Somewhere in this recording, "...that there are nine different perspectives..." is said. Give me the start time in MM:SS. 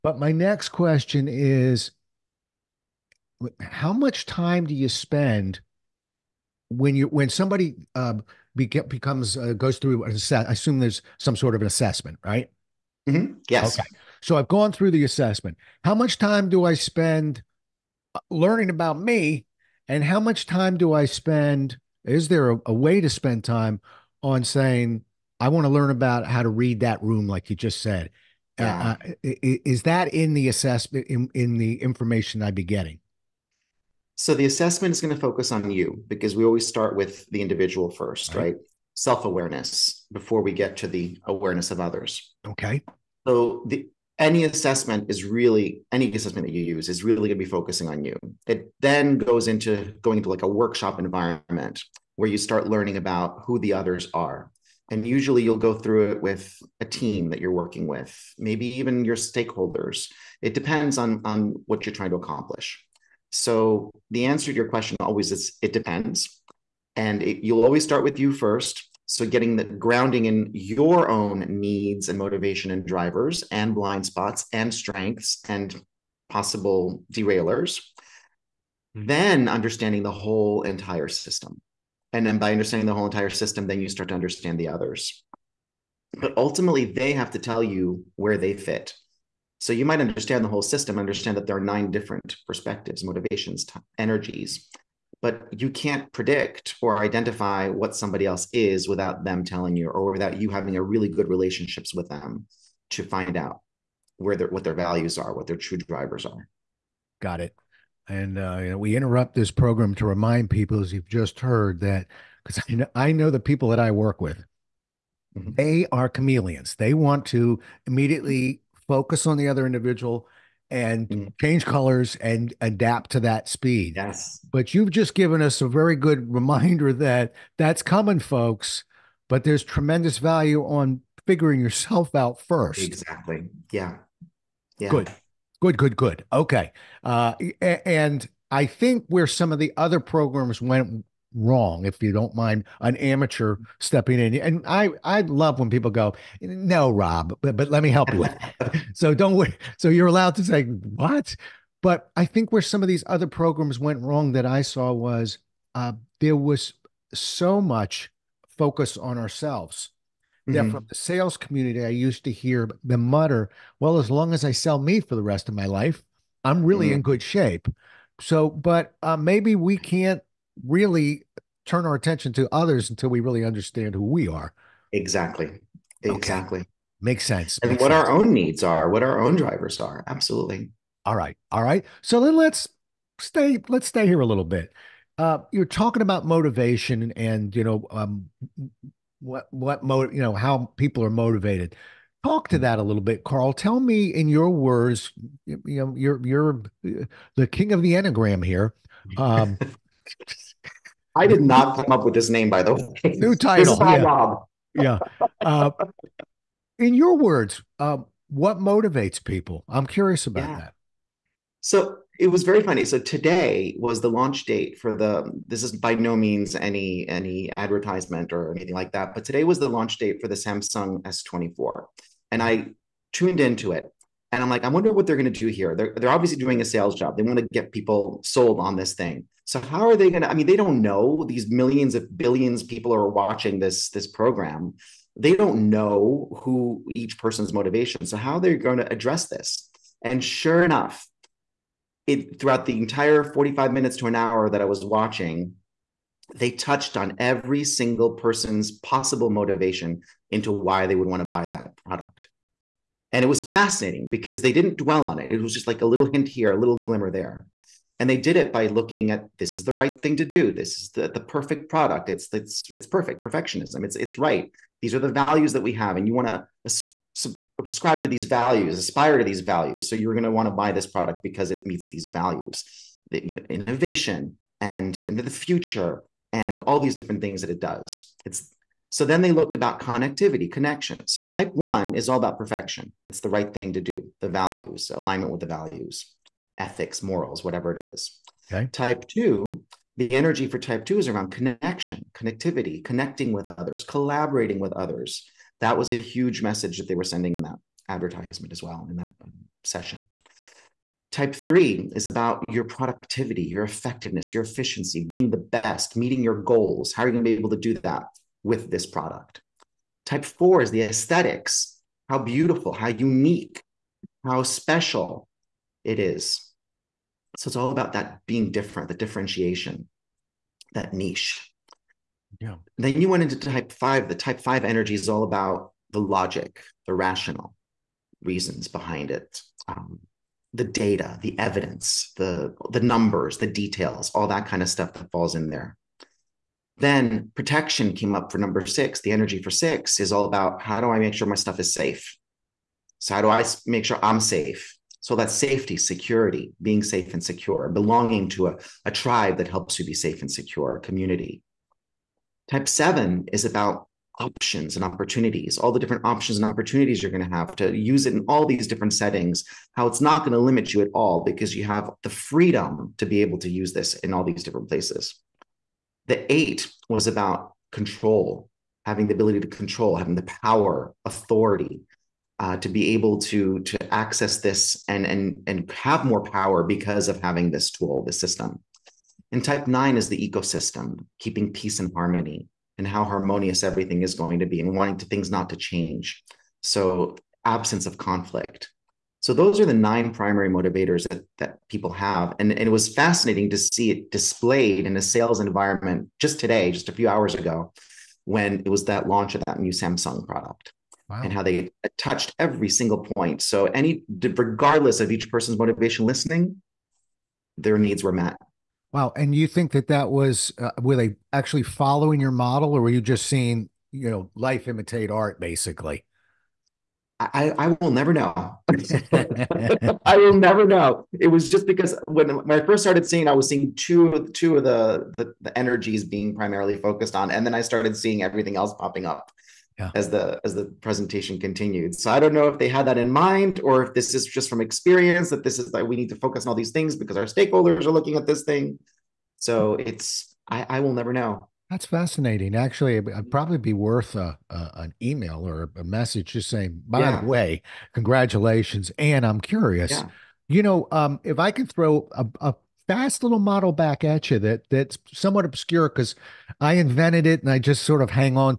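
01:31.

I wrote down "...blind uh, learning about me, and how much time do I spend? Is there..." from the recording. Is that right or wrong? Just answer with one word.
wrong.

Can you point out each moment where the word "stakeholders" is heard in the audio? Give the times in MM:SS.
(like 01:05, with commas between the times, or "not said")
00:59, 07:17.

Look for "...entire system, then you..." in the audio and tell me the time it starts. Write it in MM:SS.
01:23.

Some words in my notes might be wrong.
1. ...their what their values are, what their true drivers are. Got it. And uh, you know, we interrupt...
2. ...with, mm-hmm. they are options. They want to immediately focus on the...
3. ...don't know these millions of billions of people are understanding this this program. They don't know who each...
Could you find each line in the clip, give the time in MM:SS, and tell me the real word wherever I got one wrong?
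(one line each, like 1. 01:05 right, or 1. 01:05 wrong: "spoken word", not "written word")
1. 01:44 right
2. 01:54 wrong: "chameleons", not "options"
3. 03:50 wrong: "watching", not "understanding".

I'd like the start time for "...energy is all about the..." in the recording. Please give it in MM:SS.
05:24.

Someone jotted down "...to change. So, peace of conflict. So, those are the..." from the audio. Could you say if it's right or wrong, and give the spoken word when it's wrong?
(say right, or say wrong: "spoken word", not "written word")
wrong: "absence", not "peace".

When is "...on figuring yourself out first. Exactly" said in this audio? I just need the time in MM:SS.
02:10.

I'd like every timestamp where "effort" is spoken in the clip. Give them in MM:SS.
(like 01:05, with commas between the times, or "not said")
not said.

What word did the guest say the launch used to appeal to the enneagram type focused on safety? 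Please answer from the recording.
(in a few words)
protection.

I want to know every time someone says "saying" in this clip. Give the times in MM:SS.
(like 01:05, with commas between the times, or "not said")
00:24, 07:26.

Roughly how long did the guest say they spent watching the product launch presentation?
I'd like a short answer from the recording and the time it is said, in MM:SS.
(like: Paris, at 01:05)
45 minutes to an hour, at 04:03.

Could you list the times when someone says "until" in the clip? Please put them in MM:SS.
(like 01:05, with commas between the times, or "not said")
02:52.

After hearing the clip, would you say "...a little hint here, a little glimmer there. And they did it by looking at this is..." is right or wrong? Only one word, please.
right.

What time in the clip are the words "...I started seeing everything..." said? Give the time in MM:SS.
07:07.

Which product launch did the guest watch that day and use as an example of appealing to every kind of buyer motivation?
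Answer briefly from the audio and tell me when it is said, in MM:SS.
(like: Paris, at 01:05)
Samsung S24, at 03:40.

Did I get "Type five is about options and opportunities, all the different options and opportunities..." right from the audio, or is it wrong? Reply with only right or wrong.
wrong.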